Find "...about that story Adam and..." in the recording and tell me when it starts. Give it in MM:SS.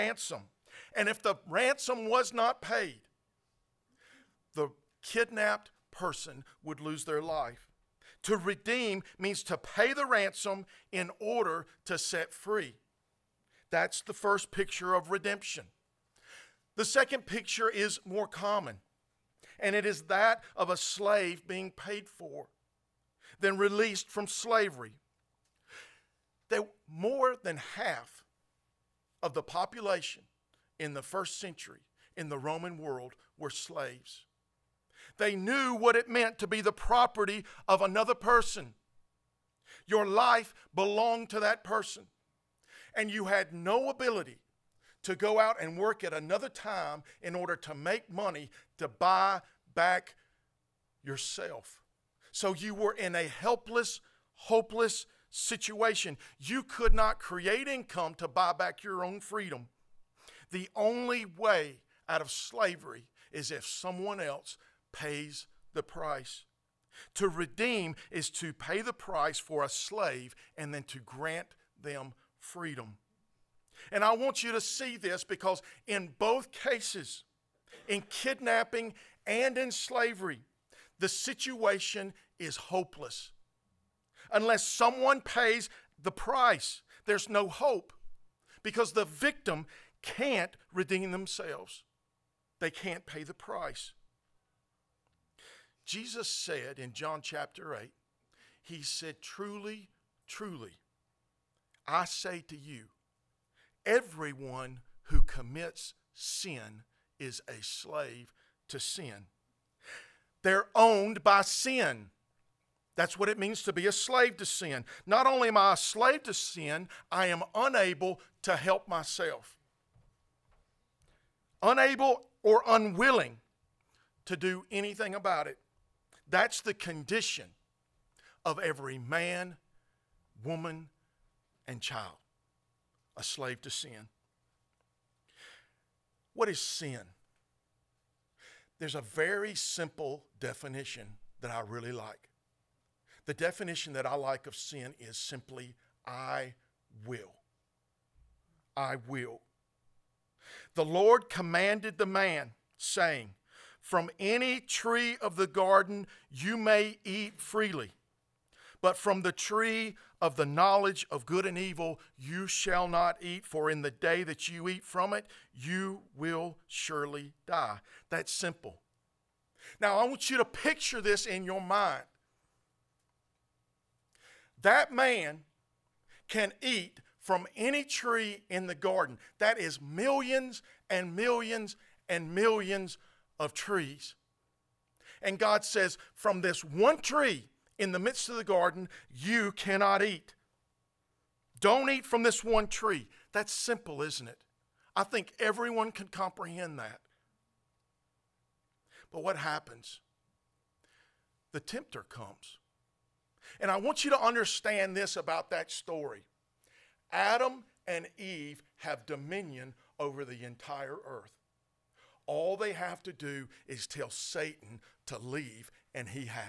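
03:25.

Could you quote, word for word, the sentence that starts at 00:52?
So you were in a helpless, hopeless situation.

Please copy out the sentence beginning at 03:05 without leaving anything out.
And God says, From this one tree in the midst of the garden, you cannot eat.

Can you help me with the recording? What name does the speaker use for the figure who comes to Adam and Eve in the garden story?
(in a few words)
The tempter.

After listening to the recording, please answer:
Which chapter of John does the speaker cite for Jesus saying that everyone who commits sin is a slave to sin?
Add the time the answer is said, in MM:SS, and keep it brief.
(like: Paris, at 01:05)
chapter 8, at 01:37.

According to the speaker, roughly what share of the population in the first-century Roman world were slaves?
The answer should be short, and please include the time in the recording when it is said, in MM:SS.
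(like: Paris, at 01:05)
more than half, at 00:26.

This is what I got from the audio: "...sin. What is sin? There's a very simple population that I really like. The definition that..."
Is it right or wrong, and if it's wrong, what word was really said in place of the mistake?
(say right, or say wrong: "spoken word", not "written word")
wrong: "definition", not "population".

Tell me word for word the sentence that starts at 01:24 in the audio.
Unless someone pays the price, there's no hope because the victim can't redeem themselves.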